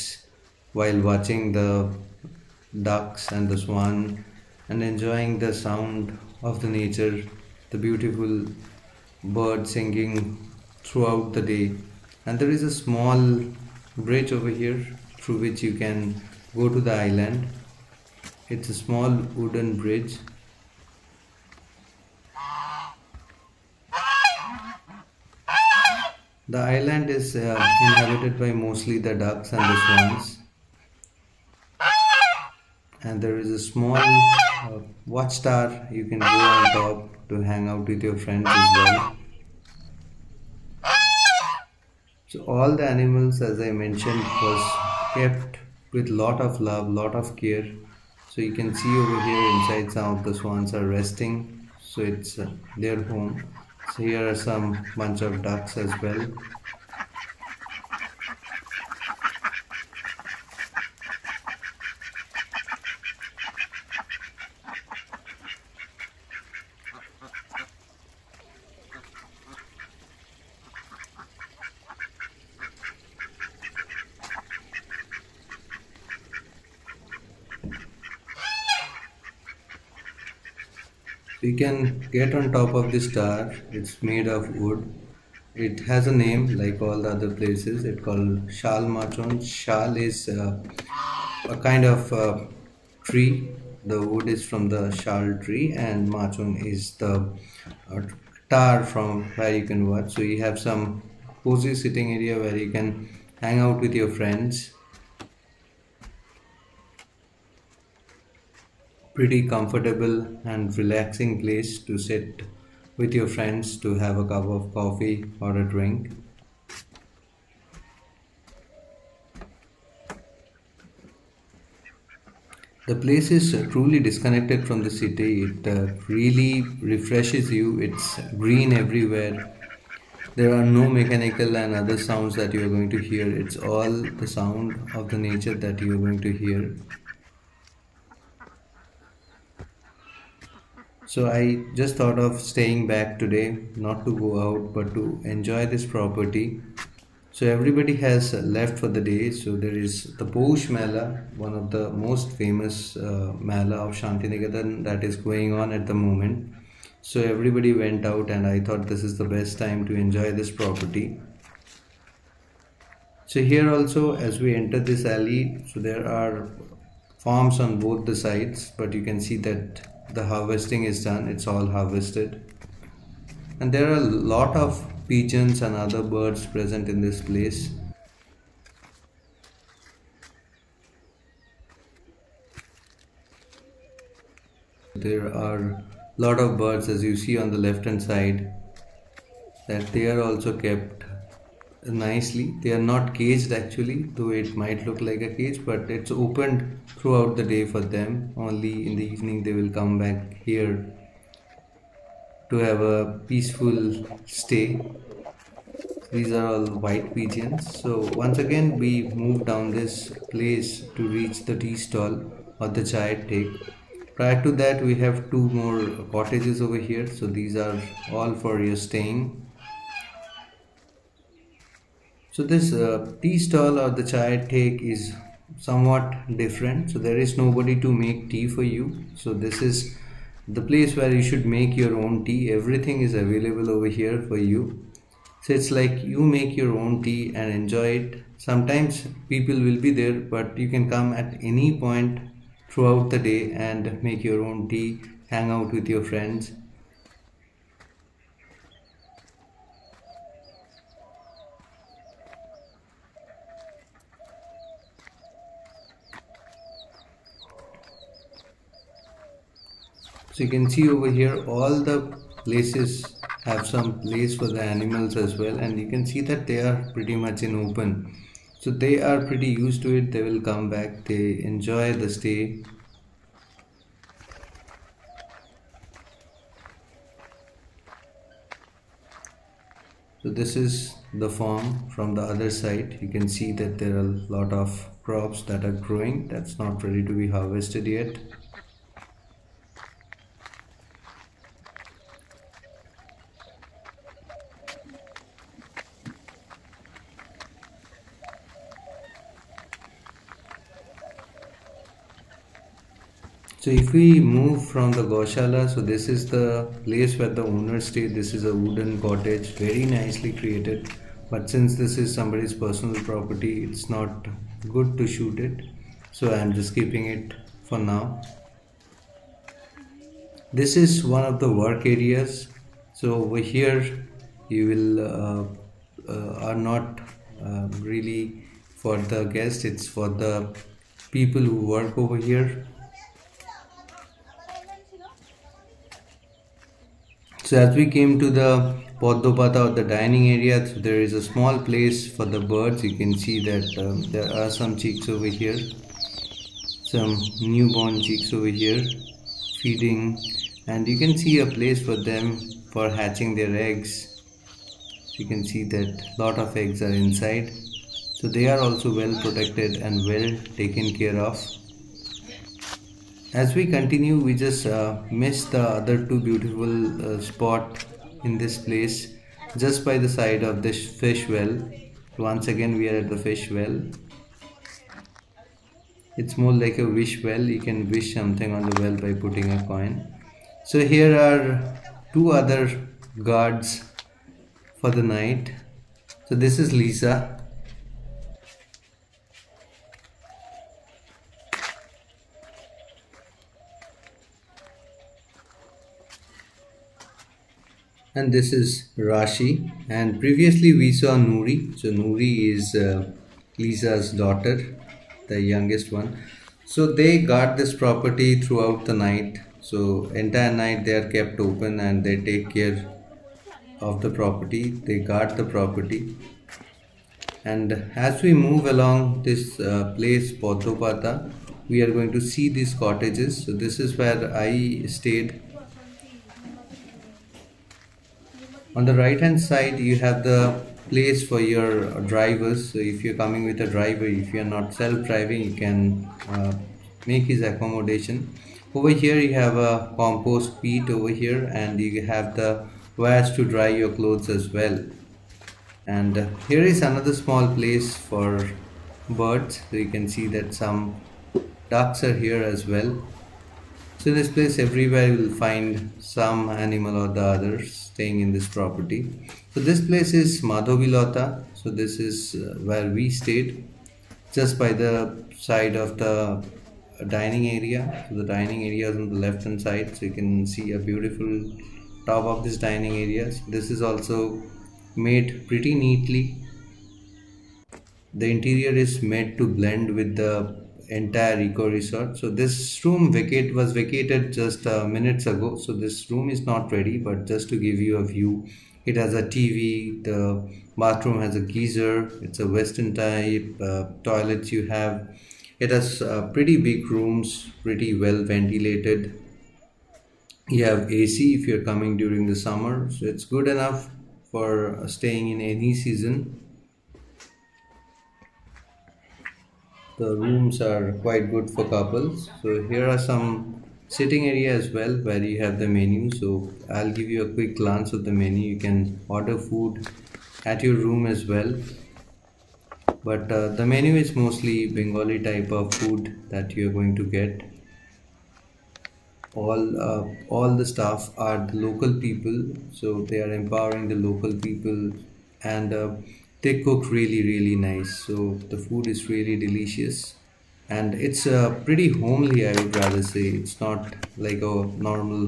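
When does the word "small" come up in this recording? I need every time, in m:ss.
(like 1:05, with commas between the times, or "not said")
0:12, 0:18, 0:33, 5:41, 7:27.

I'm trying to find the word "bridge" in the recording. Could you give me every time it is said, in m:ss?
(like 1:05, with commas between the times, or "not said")
0:13, 0:19.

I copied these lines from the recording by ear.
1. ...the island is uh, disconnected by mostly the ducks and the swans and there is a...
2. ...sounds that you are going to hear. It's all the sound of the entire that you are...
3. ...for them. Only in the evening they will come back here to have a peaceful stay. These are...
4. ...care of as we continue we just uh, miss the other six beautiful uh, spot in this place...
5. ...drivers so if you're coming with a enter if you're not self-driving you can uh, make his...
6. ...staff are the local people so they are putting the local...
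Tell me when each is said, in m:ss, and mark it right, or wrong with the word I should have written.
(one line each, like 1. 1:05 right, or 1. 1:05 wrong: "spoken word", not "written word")
1. 0:26 wrong: "inhabited", not "disconnected"
2. 2:11 wrong: "nature", not "entire"
3. 3:17 right
4. 6:00 wrong: "two", not "six"
5. 7:12 wrong: "driver", not "enter"
6. 8:50 wrong: "empowering", not "putting".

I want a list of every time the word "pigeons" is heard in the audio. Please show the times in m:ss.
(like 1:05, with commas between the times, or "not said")
2:55, 3:27.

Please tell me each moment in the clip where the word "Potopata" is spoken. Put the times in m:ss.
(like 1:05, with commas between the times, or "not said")
7:00.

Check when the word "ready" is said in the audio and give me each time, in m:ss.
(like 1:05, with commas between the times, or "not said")
4:46, 8:06.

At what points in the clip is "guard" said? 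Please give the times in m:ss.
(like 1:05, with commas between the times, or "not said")
6:23, 6:47, 6:54.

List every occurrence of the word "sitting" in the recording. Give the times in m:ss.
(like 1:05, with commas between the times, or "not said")
1:41, 8:33.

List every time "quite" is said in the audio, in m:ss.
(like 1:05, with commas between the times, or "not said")
8:31.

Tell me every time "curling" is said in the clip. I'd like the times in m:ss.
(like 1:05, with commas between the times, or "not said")
not said.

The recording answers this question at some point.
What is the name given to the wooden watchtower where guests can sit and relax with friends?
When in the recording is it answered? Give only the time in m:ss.
1:28.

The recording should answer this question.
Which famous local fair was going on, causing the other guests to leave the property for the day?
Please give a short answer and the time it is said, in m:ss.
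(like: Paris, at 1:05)
Poush Mela, at 2:30.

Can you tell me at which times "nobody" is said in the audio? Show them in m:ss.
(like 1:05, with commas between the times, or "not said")
3:47.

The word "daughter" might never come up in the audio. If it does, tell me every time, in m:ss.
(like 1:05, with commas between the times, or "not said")
6:44.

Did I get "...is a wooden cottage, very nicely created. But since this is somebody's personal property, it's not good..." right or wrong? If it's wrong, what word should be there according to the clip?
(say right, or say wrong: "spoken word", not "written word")
right.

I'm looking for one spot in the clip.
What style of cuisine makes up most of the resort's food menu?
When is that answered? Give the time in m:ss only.
8:44.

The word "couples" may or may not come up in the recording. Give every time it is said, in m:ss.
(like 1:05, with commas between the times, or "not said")
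8:31.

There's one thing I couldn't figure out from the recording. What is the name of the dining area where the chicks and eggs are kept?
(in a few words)
Poddopata.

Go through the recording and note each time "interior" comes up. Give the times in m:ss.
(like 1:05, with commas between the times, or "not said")
7:58.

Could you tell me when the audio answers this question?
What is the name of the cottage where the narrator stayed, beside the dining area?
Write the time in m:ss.
7:40.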